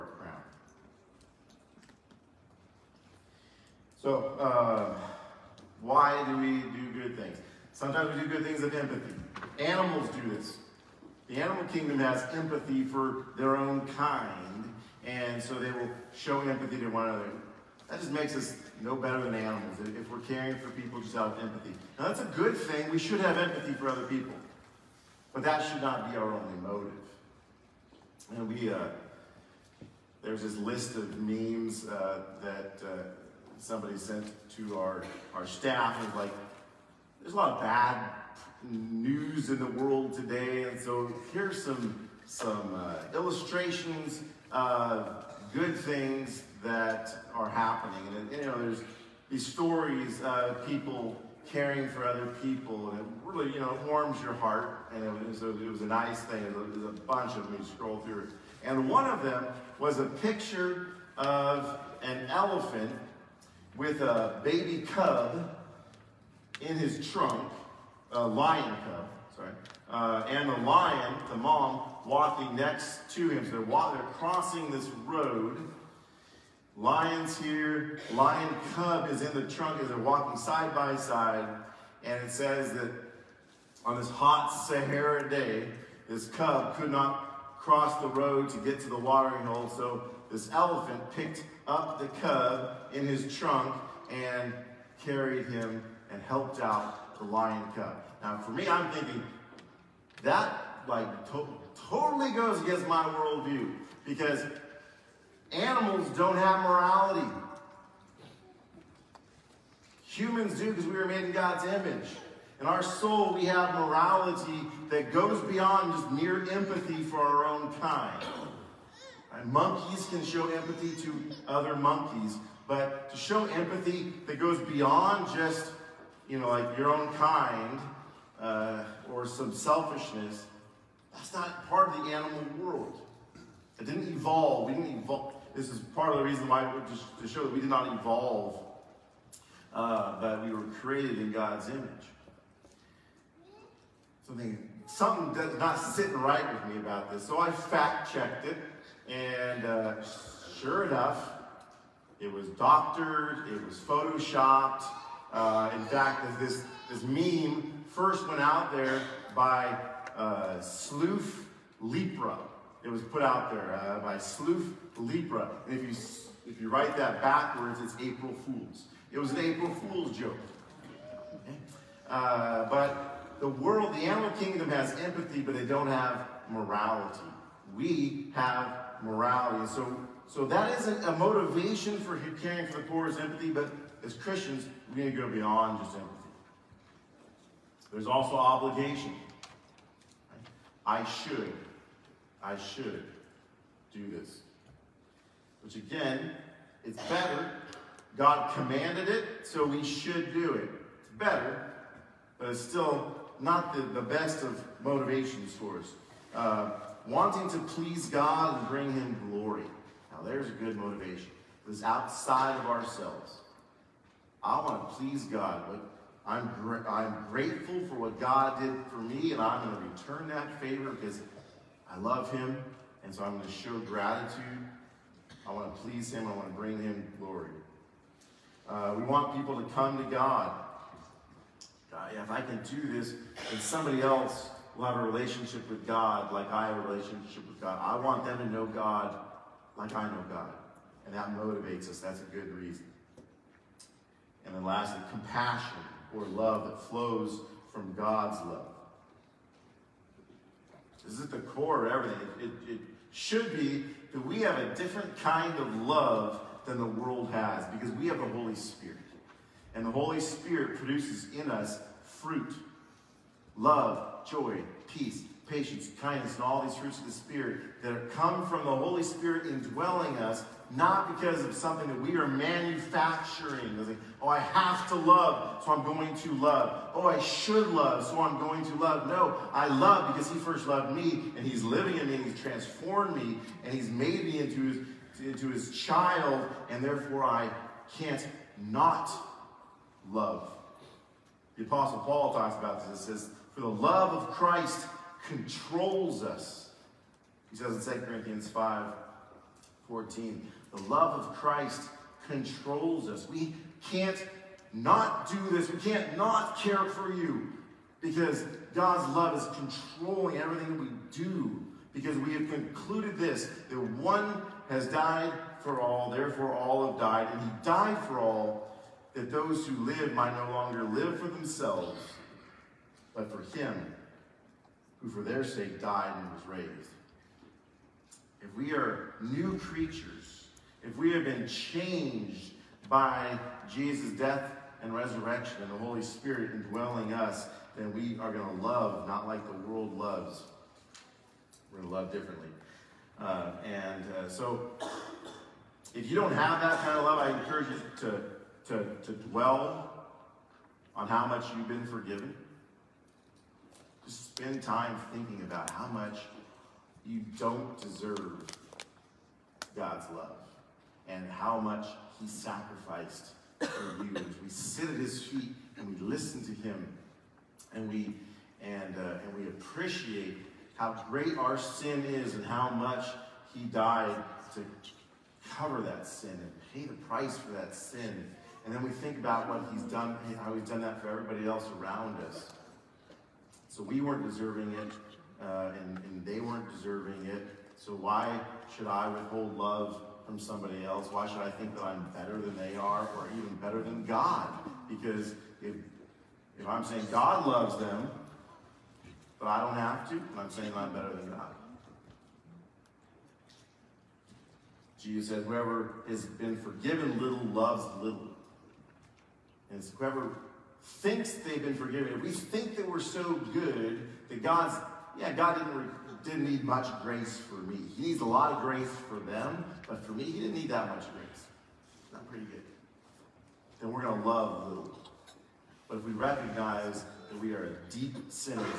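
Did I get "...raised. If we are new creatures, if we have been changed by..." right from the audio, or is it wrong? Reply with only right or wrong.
right.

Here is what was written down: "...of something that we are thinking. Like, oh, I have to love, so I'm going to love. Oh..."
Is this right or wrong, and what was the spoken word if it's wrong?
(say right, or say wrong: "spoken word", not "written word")
wrong: "manufacturing", not "thinking".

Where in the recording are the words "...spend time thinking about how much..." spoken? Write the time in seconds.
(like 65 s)
354 s.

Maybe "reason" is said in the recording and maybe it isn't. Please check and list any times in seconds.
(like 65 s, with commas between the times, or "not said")
136 s, 242 s.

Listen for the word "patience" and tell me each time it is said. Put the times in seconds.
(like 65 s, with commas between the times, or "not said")
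265 s.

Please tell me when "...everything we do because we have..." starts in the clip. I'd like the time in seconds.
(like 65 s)
310 s.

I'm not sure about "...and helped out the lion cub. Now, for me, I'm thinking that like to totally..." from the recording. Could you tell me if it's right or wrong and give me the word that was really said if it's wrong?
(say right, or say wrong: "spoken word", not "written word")
right.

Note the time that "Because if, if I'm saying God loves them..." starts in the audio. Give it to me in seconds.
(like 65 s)
394 s.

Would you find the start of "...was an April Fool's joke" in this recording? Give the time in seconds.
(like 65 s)
169 s.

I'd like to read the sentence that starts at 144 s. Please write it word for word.
Something, something does not sitting right with me about this.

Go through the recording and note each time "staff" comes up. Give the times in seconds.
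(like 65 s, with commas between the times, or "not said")
35 s.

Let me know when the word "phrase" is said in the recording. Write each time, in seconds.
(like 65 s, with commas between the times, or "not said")
not said.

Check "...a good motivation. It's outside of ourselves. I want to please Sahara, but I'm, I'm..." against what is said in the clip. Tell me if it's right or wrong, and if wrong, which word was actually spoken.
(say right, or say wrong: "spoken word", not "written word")
wrong: "God", not "Sahara".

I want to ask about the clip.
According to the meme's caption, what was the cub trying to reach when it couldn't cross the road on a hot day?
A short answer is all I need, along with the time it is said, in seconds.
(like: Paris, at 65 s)
The watering hole, at 88 s.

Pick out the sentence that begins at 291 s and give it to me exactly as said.
The Apostle Paul talks about this.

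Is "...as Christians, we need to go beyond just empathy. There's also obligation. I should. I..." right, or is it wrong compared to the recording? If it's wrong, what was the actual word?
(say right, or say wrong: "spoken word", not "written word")
right.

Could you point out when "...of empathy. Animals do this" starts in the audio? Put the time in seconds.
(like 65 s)
8 s.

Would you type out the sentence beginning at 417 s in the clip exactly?
He needs a lot of grace for them, but for me, he didn't need that much grace.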